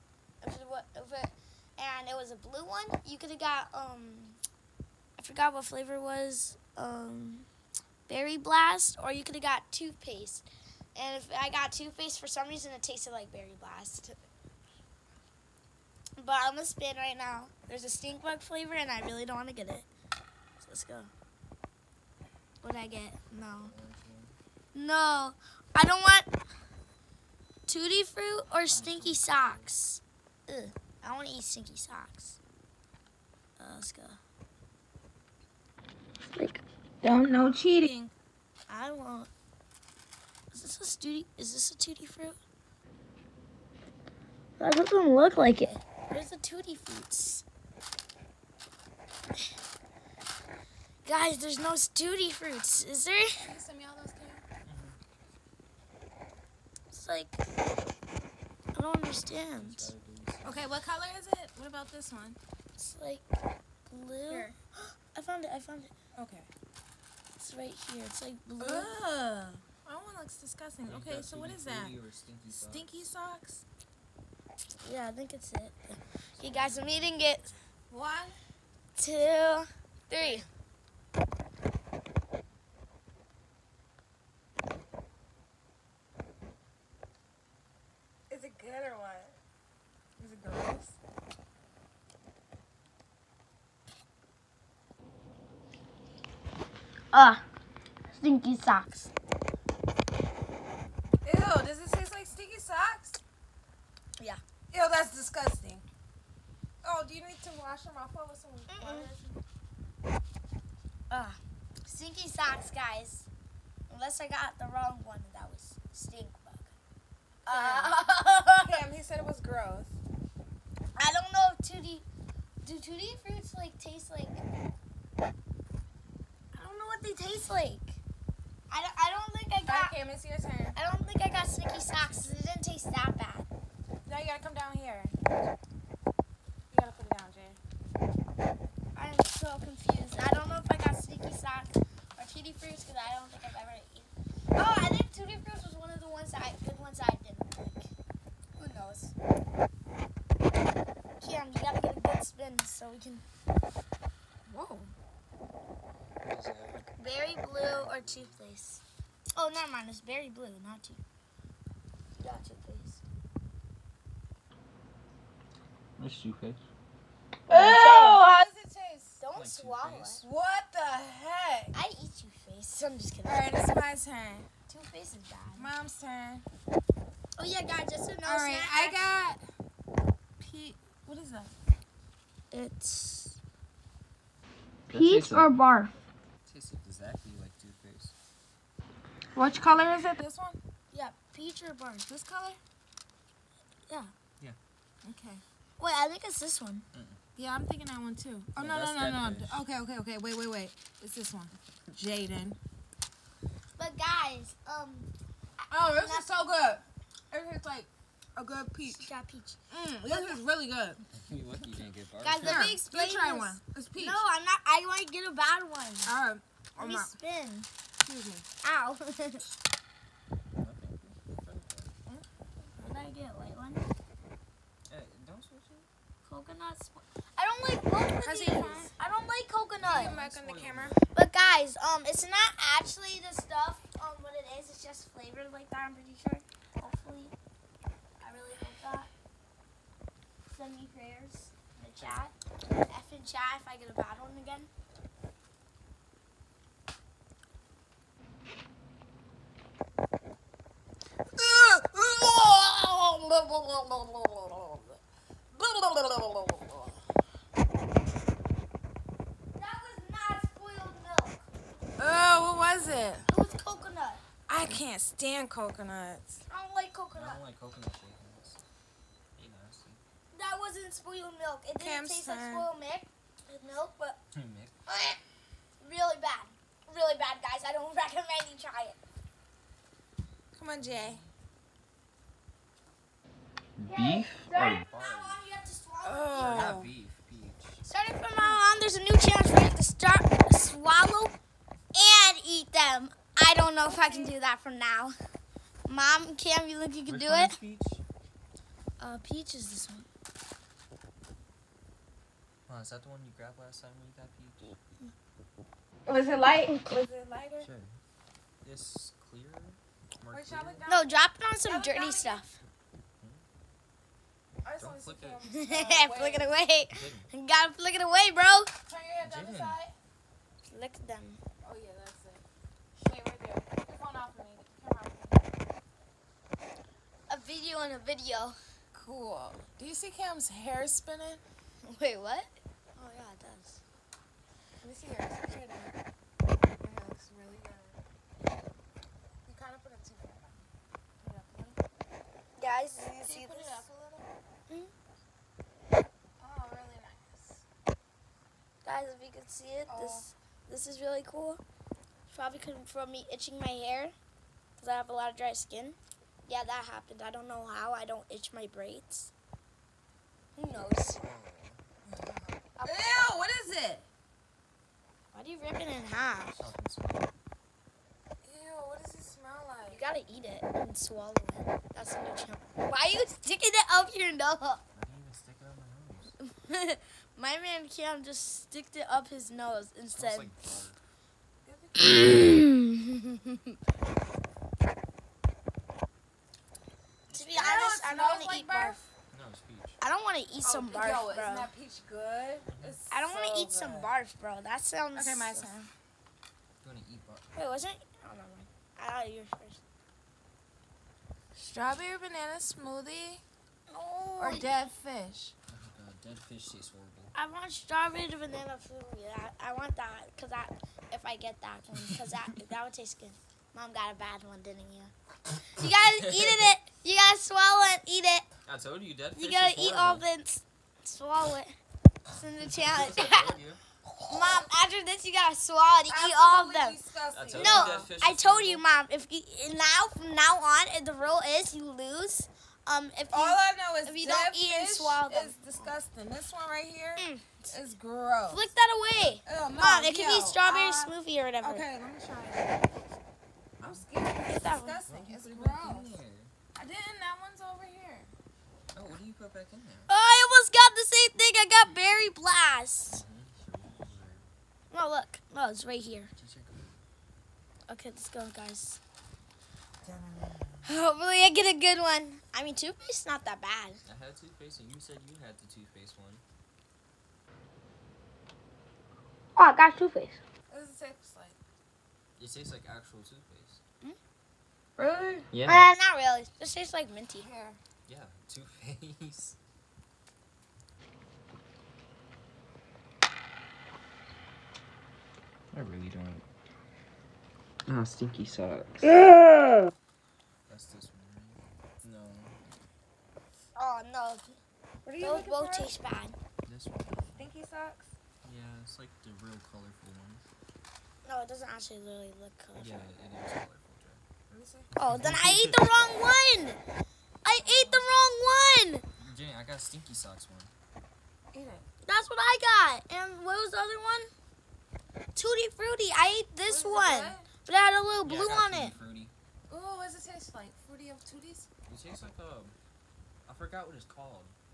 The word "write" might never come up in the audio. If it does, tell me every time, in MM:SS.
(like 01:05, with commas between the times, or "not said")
not said.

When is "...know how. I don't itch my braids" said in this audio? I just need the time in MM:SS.
05:57.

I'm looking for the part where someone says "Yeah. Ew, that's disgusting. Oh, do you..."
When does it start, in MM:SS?
01:44.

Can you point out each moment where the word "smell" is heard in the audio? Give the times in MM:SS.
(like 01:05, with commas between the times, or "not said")
06:09.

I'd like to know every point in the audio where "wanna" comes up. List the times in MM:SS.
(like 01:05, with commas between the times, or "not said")
00:19, 00:31.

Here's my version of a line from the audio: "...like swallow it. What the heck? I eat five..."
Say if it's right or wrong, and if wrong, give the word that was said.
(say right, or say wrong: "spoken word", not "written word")
wrong: "two", not "five".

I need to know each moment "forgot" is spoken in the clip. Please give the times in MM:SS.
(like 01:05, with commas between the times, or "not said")
00:05, 08:43.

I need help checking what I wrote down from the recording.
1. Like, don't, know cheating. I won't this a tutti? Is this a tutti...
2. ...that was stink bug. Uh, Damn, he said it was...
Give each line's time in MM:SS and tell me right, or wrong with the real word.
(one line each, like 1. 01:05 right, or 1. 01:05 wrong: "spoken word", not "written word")
1. 00:36 right
2. 01:55 right.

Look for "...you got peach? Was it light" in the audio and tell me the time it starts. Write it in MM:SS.
05:04.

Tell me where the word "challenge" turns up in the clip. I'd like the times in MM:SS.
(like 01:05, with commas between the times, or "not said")
04:49, 07:02.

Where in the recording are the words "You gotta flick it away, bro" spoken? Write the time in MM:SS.
05:17.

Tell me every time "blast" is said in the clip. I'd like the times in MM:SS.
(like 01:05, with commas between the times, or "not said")
00:08, 00:13, 07:32.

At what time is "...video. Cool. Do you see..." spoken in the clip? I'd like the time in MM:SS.
05:28.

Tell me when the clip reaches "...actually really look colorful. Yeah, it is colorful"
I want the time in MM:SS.
08:21.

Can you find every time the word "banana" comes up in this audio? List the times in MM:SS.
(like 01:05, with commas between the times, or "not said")
06:42, 06:48.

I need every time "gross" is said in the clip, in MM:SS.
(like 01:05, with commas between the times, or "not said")
01:30, 01:59, 07:17, 07:25.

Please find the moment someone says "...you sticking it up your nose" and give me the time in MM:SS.
06:13.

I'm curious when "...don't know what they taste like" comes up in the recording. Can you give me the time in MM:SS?
02:06.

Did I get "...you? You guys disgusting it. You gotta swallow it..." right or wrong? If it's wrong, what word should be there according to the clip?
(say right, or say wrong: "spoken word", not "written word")
wrong: "eating", not "disgusting".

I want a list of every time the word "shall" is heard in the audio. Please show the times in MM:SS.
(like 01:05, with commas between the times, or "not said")
05:11.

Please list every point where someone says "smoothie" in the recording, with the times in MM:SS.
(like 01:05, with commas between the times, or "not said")
06:42, 06:48, 07:21.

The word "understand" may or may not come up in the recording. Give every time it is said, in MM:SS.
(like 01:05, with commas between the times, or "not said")
00:58.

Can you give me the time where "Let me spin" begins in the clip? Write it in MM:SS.
03:36.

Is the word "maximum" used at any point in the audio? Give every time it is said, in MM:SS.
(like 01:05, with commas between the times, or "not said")
not said.